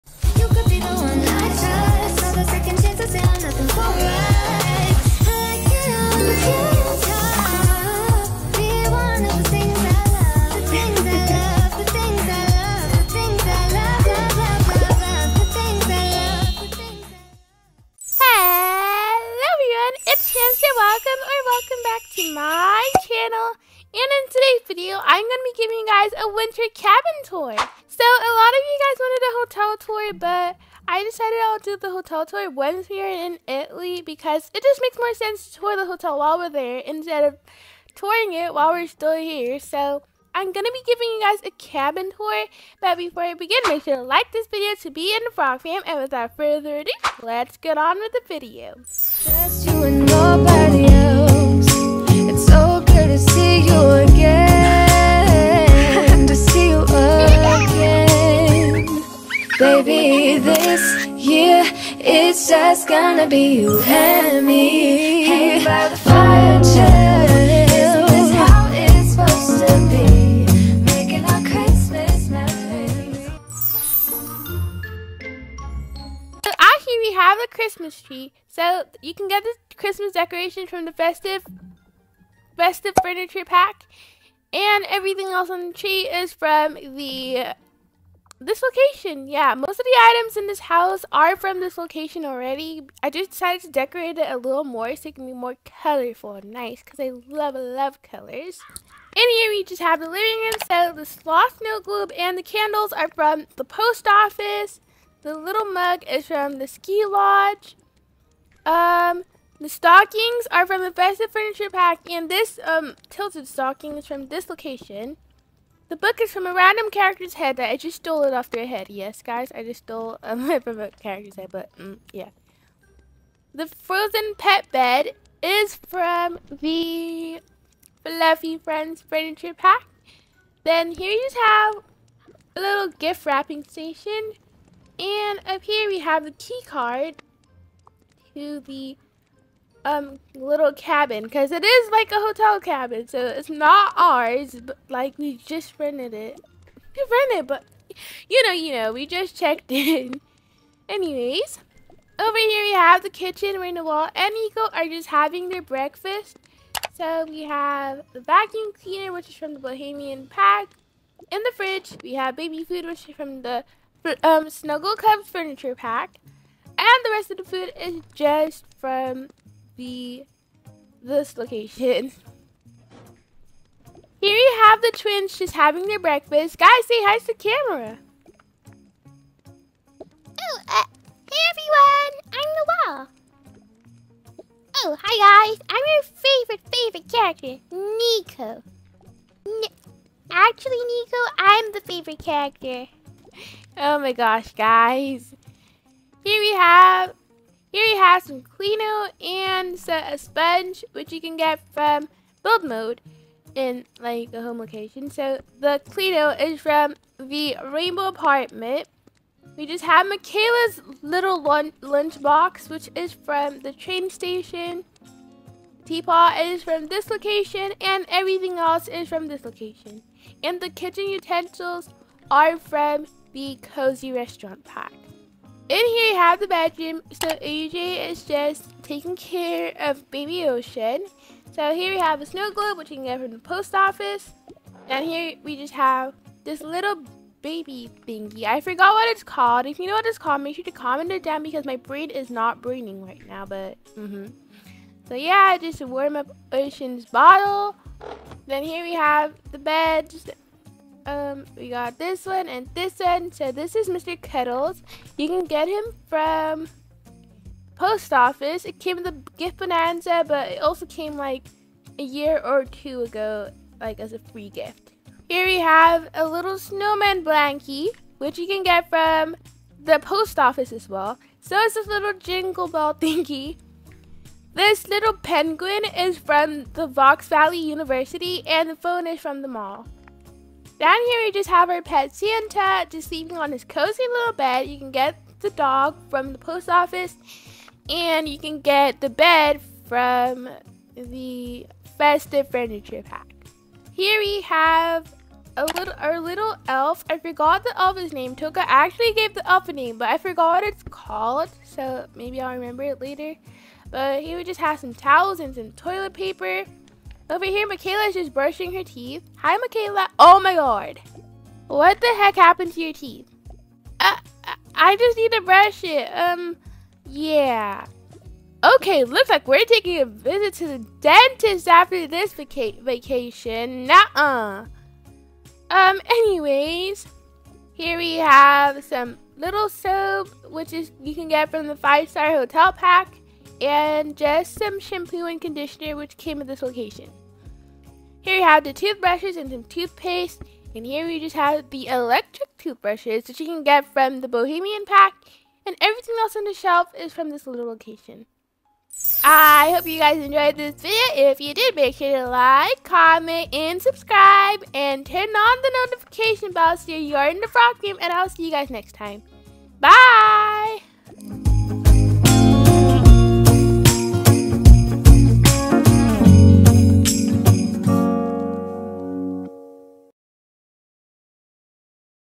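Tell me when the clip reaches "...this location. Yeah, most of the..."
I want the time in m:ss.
1:28.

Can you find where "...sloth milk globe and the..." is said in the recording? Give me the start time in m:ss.
1:41.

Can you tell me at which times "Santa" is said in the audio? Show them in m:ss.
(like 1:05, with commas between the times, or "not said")
4:42.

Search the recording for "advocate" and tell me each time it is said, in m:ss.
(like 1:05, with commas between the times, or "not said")
not said.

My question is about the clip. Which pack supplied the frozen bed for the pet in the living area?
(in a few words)
Fluffy Friends Furniture Pack.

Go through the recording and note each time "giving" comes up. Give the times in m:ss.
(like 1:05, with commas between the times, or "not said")
0:25, 0:40.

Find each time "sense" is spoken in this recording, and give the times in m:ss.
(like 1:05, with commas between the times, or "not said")
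0:35.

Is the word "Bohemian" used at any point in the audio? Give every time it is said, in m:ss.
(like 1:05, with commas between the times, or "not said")
2:39, 5:44.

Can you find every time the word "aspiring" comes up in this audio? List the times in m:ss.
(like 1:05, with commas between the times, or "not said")
not said.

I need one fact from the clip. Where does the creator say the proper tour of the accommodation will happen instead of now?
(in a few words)
Italy.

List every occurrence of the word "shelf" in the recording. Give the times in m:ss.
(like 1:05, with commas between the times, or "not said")
5:46.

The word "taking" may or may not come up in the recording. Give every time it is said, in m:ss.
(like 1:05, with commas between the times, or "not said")
3:48, 5:19.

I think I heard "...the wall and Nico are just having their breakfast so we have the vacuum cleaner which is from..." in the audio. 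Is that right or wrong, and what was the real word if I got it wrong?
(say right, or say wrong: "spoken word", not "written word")
right.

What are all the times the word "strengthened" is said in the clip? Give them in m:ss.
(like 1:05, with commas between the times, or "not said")
not said.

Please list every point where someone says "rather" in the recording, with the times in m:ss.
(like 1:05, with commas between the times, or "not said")
not said.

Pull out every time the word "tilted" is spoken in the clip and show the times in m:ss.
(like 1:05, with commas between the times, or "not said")
1:53.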